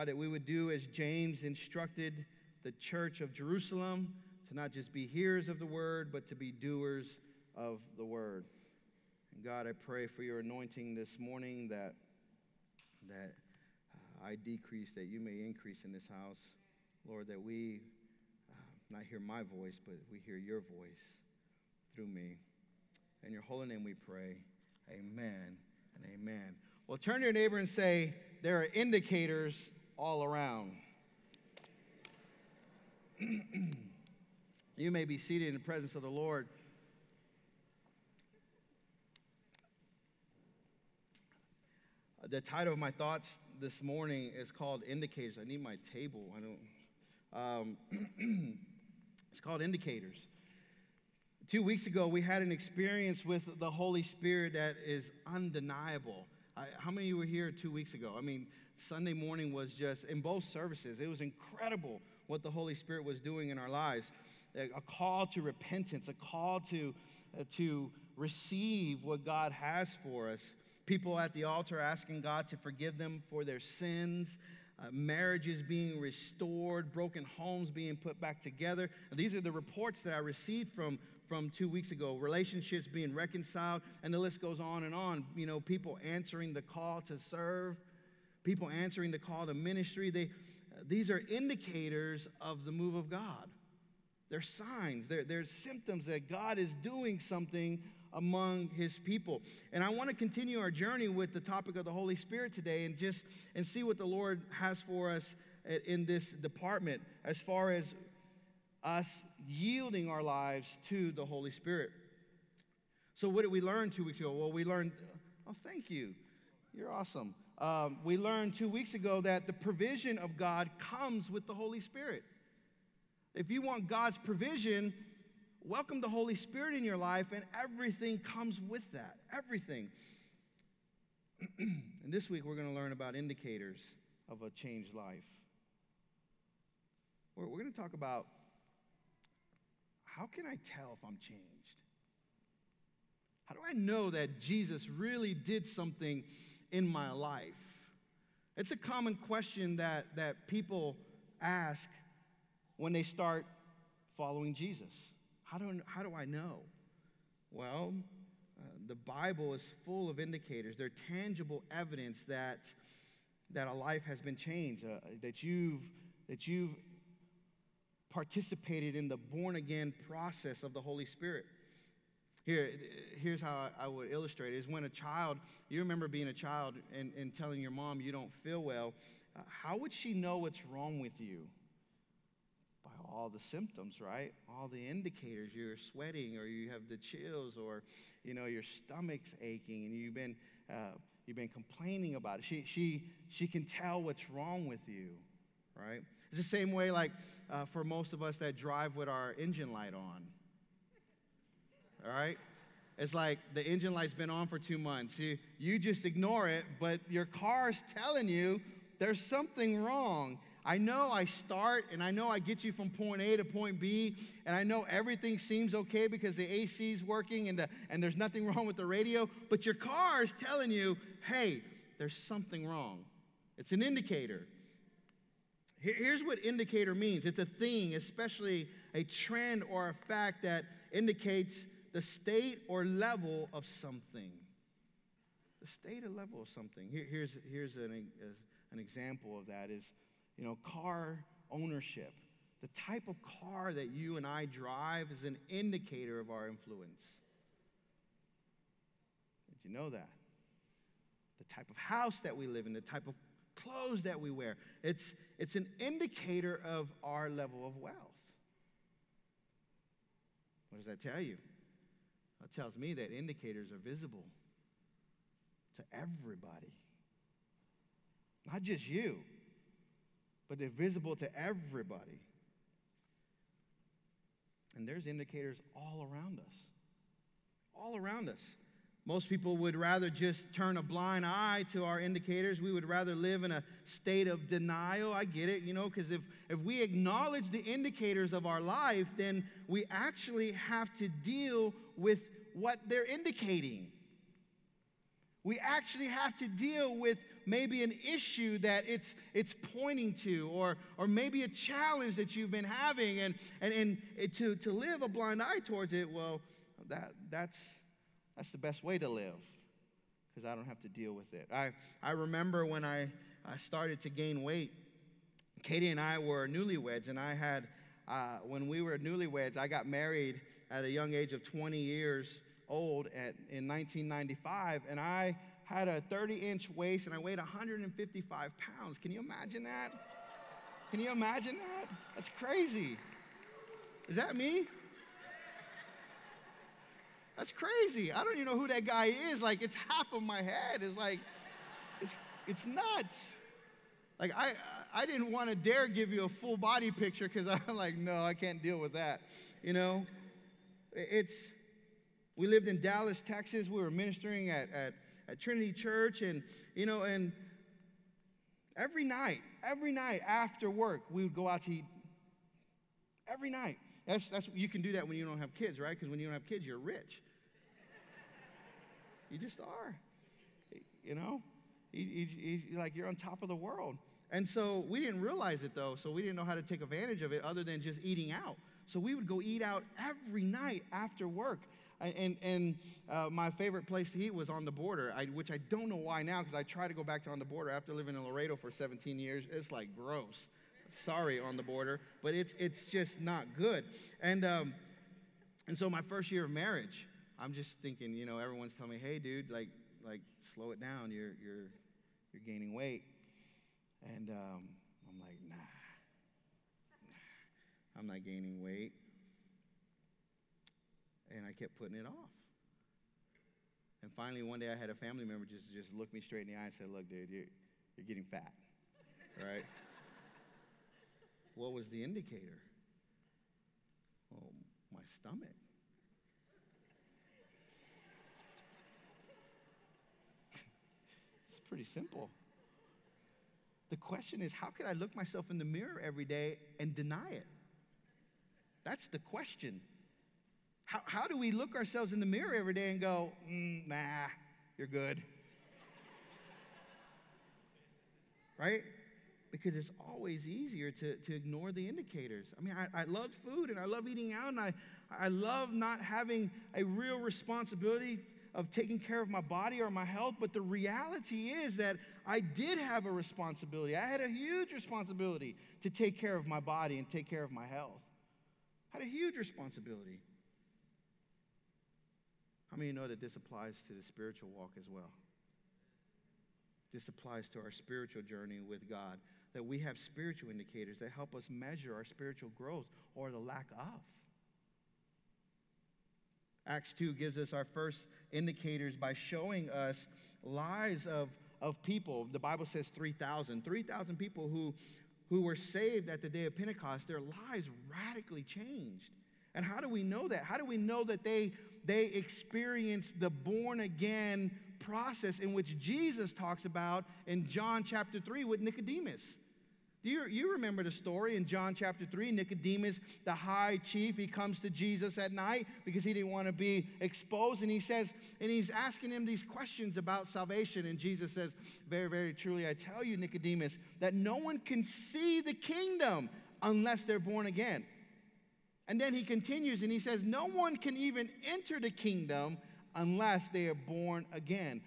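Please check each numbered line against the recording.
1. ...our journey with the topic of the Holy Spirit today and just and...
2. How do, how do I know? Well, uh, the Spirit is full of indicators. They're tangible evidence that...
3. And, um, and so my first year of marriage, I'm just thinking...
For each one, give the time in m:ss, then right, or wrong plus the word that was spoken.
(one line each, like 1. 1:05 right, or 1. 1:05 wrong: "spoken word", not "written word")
1. 1:40 right
2. 2:35 wrong: "Bible", not "Spirit"
3. 6:34 right.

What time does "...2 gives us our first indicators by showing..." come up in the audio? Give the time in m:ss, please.
8:06.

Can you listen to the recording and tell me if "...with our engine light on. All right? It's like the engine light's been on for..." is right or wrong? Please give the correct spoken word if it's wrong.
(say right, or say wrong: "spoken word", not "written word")
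right.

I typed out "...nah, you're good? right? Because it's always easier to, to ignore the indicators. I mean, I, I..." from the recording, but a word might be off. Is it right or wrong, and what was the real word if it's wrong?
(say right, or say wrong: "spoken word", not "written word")
right.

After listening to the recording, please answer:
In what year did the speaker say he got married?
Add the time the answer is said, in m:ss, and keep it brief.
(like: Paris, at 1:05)
1995, at 5:23.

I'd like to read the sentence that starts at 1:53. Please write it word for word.
So, what did we learn two weeks ago?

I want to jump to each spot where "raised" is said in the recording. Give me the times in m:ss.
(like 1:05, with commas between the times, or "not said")
not said.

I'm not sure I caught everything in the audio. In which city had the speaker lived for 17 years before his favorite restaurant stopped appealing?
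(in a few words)
Laredo.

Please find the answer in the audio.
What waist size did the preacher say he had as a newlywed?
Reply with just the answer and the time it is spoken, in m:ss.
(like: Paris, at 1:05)
30 inch, at 5:26.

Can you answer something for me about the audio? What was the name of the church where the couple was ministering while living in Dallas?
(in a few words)
Trinity Church.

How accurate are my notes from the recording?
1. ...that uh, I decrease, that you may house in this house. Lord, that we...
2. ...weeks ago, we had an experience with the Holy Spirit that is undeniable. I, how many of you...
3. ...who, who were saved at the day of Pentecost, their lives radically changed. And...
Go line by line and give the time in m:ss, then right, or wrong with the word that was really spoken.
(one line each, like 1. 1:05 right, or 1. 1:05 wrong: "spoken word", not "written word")
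1. 0:13 wrong: "increase", not "house"
2. 0:51 right
3. 8:14 right.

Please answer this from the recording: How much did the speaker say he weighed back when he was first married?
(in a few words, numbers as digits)
155 pounds.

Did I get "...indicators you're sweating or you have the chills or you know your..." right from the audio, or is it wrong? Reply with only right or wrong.
right.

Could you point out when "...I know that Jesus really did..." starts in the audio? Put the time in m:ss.
2:23.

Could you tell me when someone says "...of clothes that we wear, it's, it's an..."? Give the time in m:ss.
4:13.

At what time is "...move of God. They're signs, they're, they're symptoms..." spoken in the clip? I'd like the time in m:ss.
1:32.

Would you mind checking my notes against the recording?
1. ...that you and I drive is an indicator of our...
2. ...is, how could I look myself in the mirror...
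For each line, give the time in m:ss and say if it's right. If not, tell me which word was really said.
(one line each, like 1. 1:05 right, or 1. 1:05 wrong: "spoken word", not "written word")
1. 4:03 right
2. 7:14 right.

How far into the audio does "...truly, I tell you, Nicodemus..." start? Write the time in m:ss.
8:42.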